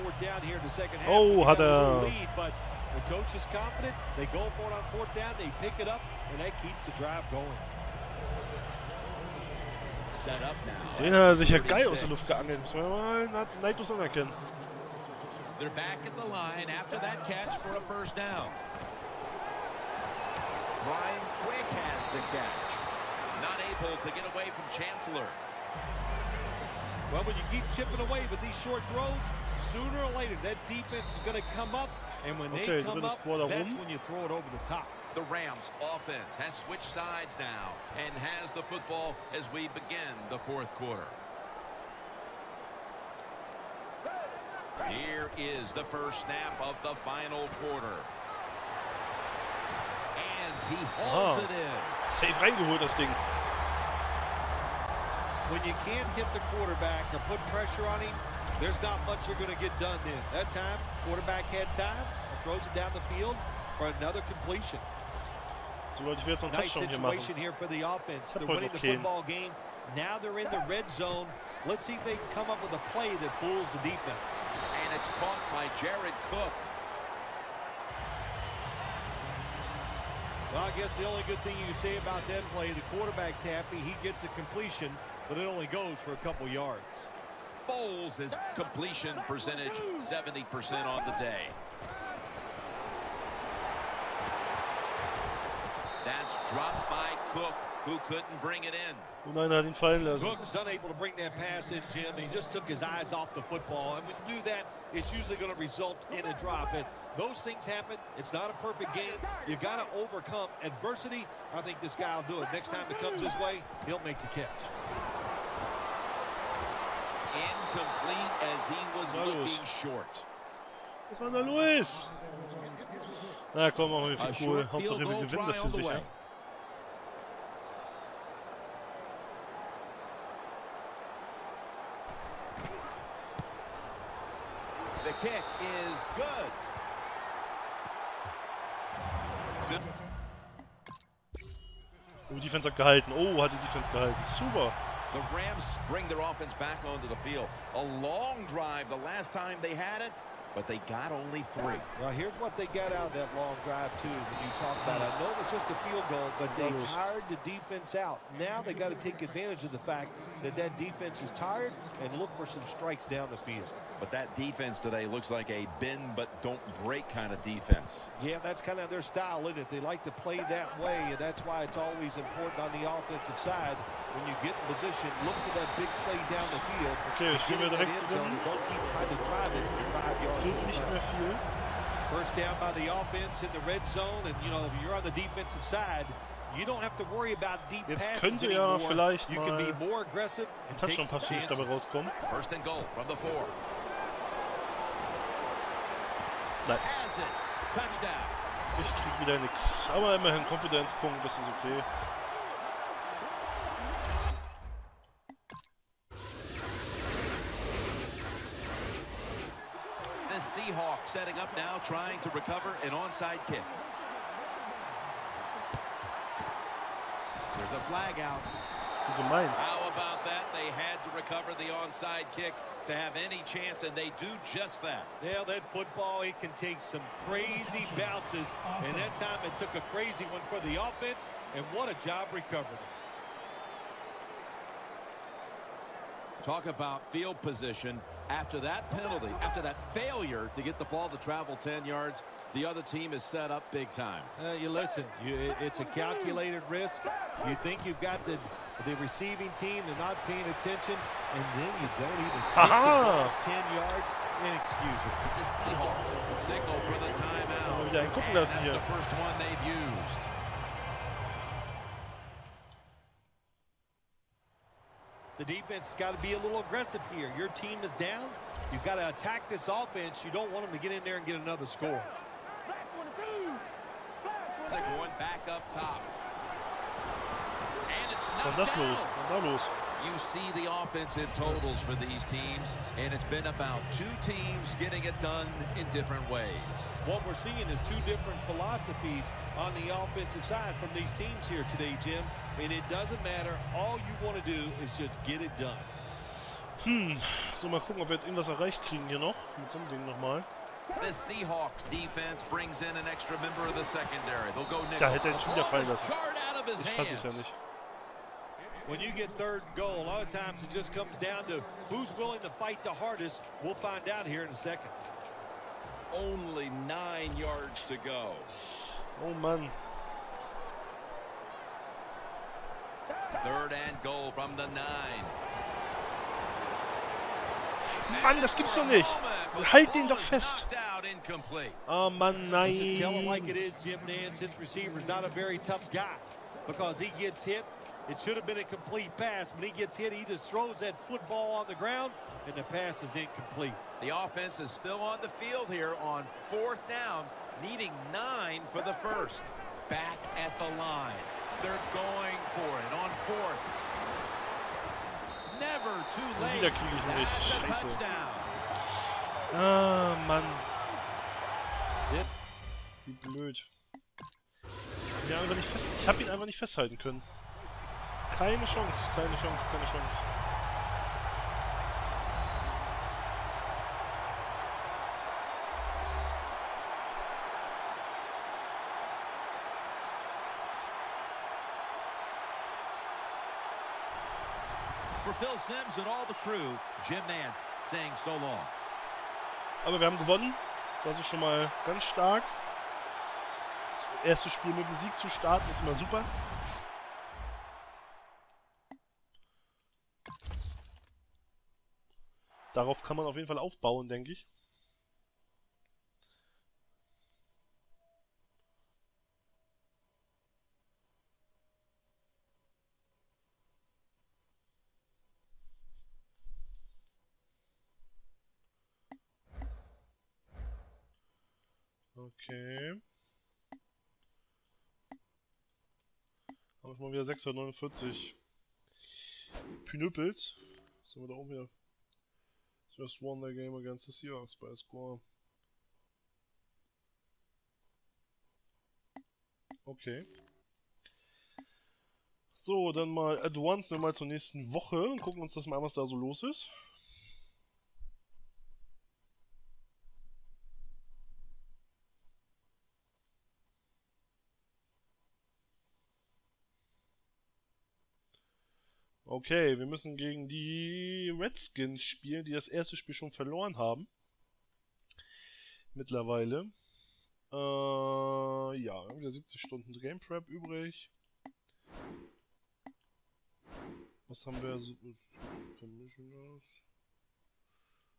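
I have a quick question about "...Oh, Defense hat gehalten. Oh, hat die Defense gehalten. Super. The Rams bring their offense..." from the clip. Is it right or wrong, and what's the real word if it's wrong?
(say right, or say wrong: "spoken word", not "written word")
right.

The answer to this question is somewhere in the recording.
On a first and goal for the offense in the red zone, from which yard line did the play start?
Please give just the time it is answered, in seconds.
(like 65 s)
193 s.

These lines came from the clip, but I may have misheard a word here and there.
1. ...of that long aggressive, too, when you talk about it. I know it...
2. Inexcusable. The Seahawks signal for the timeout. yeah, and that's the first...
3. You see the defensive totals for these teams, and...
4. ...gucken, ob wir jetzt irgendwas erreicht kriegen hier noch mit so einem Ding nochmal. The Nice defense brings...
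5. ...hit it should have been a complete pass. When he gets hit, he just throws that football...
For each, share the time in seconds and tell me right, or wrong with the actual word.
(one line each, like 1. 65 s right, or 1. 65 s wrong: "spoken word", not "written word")
1. 153 s wrong: "drive", not "aggressive"
2. 254 s right
3. 280 s wrong: "offensive", not "defensive"
4. 297 s wrong: "Seahawks", not "Nice"
5. 337 s right.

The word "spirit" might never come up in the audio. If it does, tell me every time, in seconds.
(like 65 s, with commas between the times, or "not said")
not said.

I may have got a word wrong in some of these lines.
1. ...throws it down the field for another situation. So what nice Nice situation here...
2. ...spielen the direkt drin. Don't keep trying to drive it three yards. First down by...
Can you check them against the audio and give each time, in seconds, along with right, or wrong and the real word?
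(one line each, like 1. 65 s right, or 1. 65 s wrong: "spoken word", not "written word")
1. 62 s wrong: "completion", not "situation"
2. 177 s wrong: "five", not "three".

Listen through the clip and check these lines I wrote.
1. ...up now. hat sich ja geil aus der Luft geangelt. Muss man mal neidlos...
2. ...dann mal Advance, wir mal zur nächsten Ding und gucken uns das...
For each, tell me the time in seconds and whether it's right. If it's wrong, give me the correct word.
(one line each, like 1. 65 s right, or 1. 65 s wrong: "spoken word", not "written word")
1. 10 s right
2. 442 s wrong: "Woche", not "Ding".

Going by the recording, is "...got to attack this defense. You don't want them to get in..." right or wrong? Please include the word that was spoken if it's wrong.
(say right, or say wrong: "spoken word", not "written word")
wrong: "offense", not "defense".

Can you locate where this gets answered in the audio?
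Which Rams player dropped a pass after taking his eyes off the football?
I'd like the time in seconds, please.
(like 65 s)
75 s.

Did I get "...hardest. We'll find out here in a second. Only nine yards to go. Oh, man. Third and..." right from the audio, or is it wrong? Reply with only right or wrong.
right.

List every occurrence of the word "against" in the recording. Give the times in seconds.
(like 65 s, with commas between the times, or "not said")
433 s.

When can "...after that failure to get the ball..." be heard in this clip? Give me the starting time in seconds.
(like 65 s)
239 s.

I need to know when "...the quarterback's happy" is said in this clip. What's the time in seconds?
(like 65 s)
82 s.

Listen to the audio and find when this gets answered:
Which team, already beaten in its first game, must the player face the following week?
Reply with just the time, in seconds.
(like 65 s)
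461 s.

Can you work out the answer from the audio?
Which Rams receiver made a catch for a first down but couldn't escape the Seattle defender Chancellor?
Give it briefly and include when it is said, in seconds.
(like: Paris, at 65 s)
Brian Quick, at 20 s.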